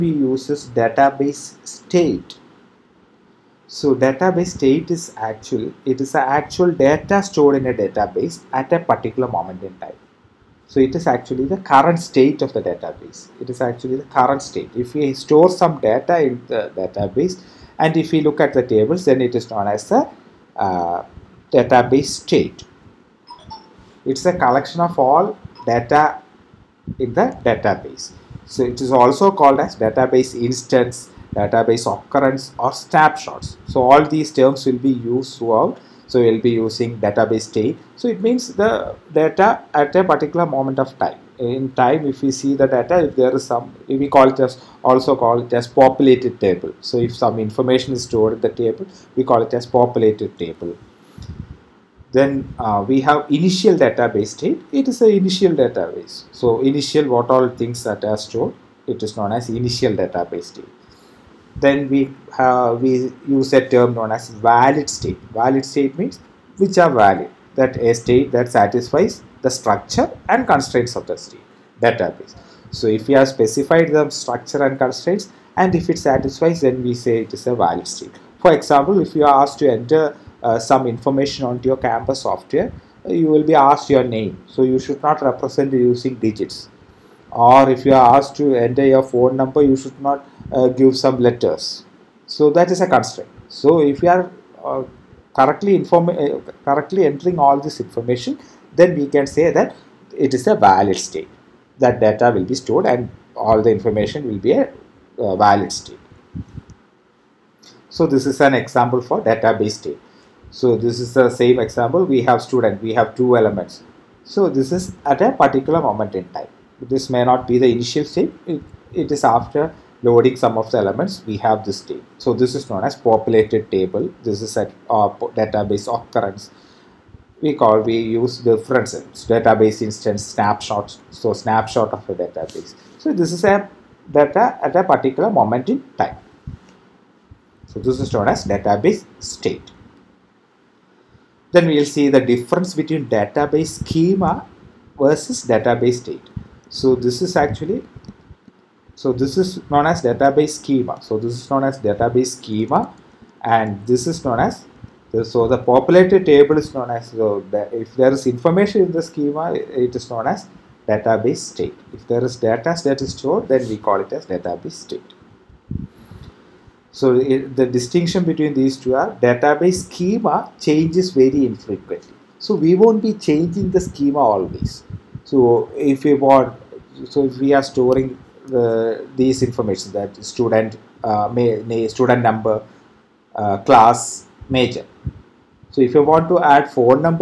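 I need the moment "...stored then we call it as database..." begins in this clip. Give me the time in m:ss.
2:43.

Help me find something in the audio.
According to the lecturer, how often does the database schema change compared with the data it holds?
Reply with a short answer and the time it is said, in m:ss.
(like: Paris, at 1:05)
very infrequently, at 2:51.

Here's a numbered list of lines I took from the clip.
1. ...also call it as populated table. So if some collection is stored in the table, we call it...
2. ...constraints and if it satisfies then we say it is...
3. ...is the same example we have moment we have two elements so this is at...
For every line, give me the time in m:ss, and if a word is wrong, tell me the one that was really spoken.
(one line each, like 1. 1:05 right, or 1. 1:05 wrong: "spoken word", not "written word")
1. 0:44 wrong: "information", not "collection"
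2. 1:14 right
3. 1:50 wrong: "student", not "moment".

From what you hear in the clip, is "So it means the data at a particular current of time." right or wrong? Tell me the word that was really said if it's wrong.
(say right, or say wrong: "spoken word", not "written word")
wrong: "moment", not "current".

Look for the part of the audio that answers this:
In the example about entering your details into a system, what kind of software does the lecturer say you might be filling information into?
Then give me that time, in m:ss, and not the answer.
1:21.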